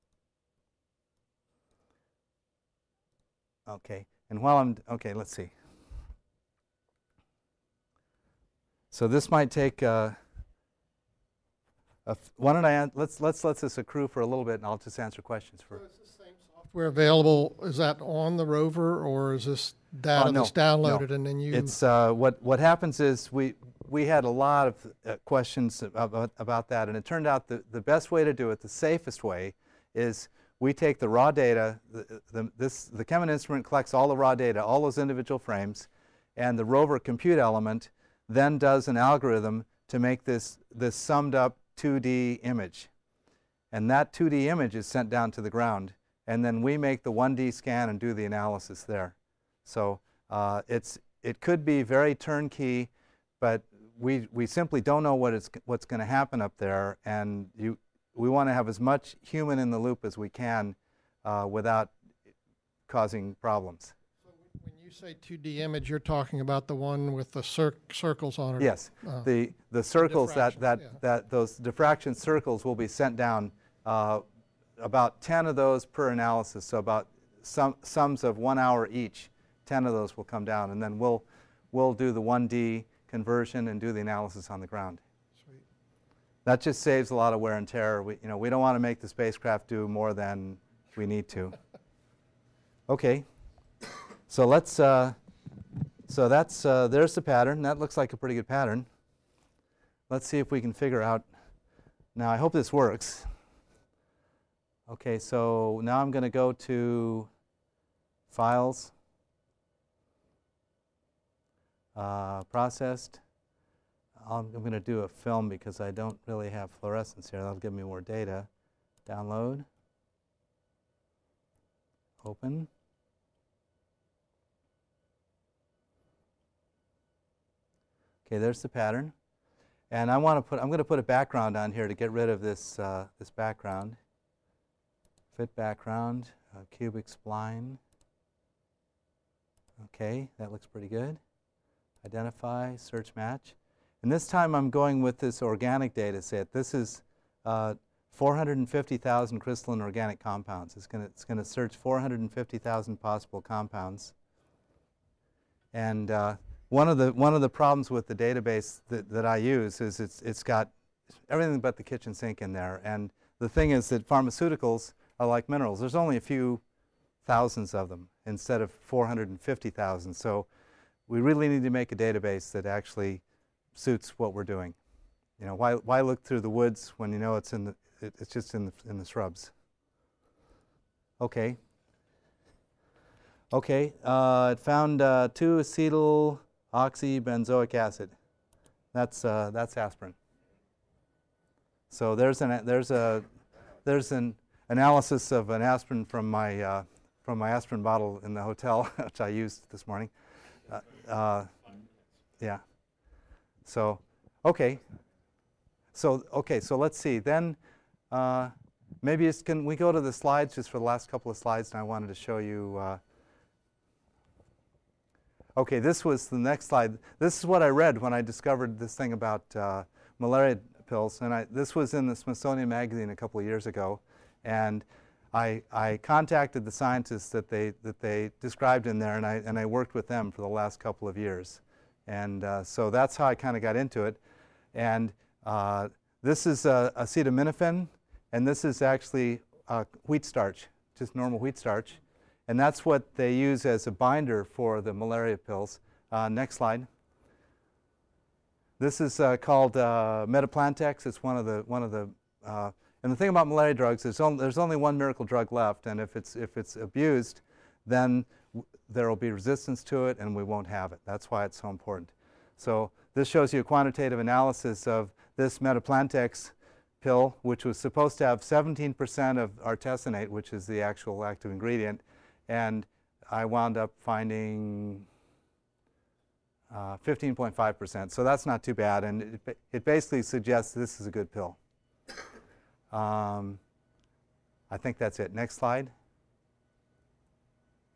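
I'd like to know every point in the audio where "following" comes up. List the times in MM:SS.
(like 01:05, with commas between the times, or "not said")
not said.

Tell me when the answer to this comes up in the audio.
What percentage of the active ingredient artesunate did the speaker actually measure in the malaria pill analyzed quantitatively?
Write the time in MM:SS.
04:36.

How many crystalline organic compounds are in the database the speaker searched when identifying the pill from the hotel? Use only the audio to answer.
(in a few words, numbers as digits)
450,000.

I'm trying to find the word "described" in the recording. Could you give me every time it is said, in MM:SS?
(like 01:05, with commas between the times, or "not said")
03:48.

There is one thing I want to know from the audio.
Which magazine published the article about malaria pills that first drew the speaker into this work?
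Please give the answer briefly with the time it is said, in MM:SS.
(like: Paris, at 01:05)
Smithsonian Magazine, at 03:42.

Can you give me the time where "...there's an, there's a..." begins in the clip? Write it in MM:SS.
03:12.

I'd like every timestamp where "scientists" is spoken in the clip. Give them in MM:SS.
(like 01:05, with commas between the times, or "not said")
03:46.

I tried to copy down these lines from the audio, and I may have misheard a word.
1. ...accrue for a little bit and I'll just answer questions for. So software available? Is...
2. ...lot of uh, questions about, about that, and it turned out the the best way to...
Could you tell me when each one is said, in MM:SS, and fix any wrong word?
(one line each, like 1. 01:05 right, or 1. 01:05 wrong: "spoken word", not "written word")
1. 00:13 right
2. 00:24 right.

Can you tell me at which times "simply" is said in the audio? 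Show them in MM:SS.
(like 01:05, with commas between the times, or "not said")
00:54.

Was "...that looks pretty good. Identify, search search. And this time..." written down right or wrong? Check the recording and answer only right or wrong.
wrong.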